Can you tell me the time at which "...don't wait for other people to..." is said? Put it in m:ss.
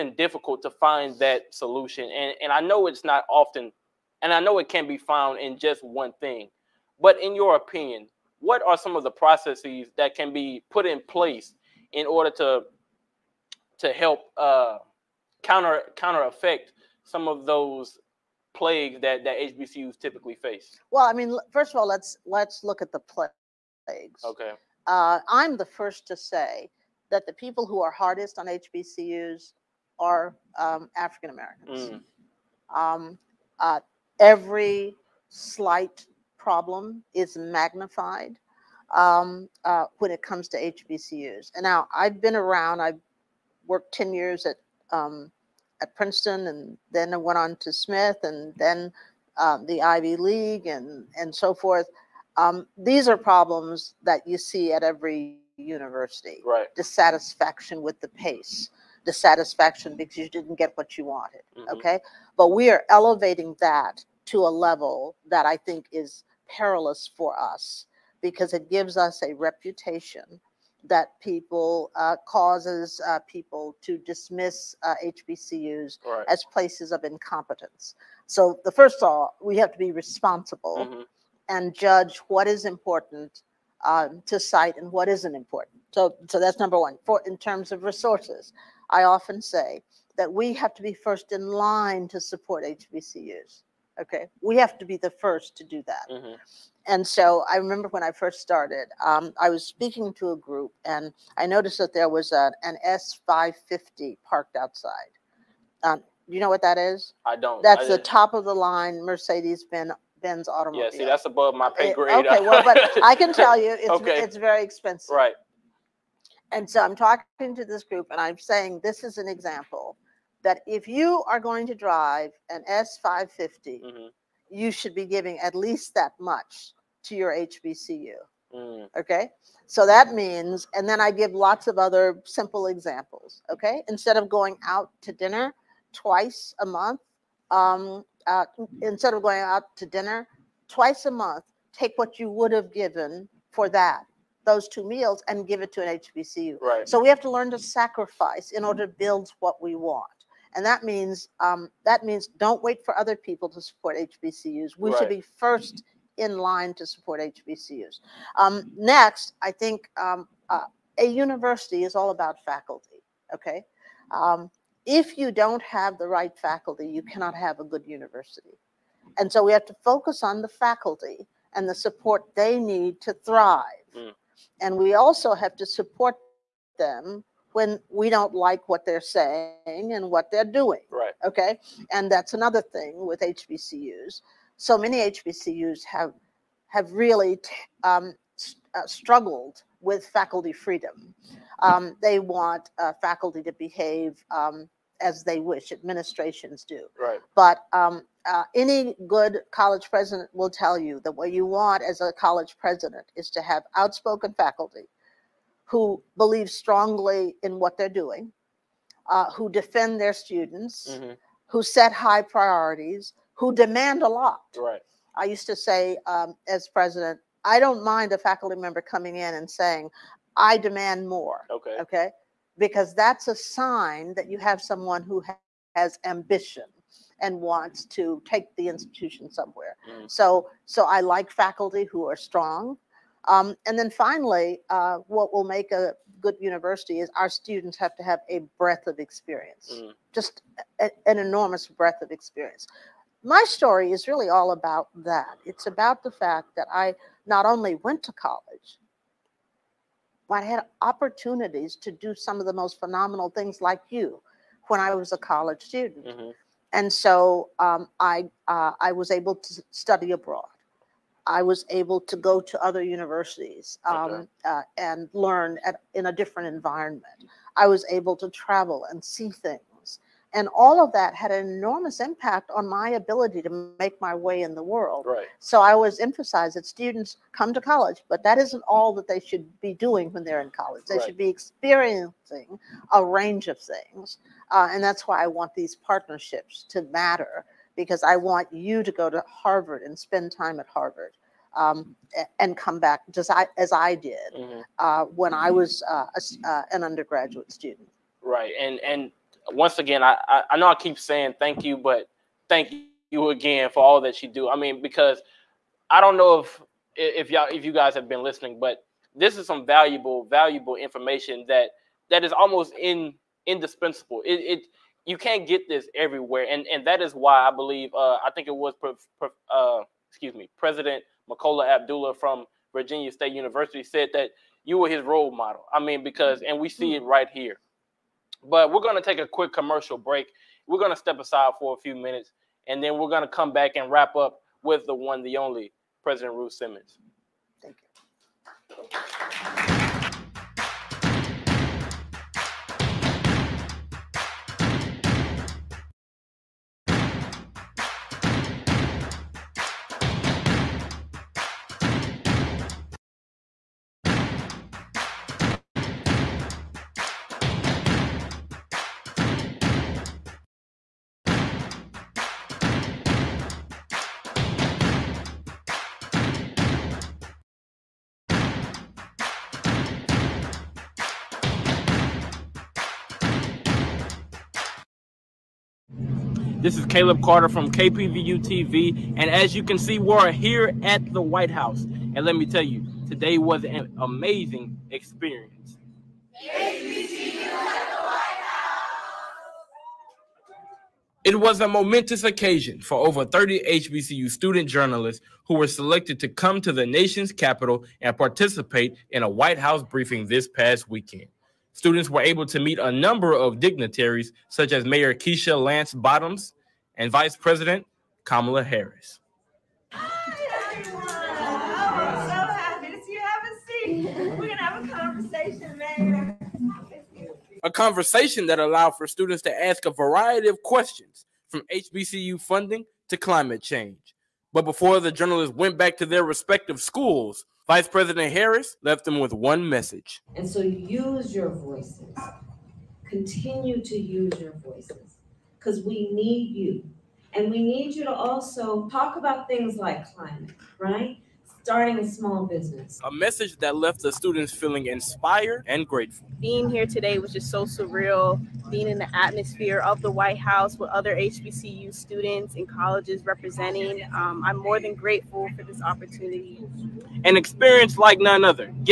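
2:32.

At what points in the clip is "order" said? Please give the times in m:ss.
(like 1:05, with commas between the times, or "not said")
0:12, 2:28.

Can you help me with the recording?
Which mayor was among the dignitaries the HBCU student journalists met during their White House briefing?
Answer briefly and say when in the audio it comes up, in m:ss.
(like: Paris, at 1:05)
Keisha Lance Bottoms, at 6:45.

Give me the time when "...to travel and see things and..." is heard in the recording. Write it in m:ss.
4:28.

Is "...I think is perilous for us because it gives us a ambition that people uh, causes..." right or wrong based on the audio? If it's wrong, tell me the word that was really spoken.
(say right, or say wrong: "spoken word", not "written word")
wrong: "reputation", not "ambition".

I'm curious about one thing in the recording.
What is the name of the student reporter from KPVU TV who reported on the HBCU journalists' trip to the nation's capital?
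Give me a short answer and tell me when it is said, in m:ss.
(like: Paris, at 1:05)
Caleb Carter, at 6:16.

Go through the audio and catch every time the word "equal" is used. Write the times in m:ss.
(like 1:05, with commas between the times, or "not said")
not said.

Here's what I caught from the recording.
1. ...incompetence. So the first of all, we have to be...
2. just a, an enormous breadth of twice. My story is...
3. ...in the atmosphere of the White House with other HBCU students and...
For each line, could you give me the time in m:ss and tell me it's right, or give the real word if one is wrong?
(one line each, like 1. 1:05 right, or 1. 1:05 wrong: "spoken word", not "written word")
1. 1:17 right
2. 4:00 wrong: "experience", not "twice"
3. 7:28 right.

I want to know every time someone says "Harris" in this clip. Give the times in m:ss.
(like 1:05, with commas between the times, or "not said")
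6:48, 7:08.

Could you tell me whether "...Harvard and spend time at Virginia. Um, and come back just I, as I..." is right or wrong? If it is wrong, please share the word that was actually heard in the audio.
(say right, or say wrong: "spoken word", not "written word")
wrong: "Harvard", not "Virginia".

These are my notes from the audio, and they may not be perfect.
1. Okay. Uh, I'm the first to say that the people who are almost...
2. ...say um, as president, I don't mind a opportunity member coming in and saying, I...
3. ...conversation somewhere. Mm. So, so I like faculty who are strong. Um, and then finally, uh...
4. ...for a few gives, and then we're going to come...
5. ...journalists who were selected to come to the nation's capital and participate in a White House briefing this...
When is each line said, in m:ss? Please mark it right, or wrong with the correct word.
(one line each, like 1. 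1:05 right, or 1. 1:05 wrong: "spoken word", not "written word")
1. 0:24 wrong: "hardest", not "almost"
2. 3:35 wrong: "faculty", not "opportunity"
3. 3:48 wrong: "institution", not "conversation"
4. 5:31 wrong: "minutes", not "gives"
5. 6:34 right.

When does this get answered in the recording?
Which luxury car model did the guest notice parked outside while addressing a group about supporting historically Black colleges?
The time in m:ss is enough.
2:02.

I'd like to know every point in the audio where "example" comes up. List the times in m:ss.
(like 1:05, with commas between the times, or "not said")
1:59, 2:12.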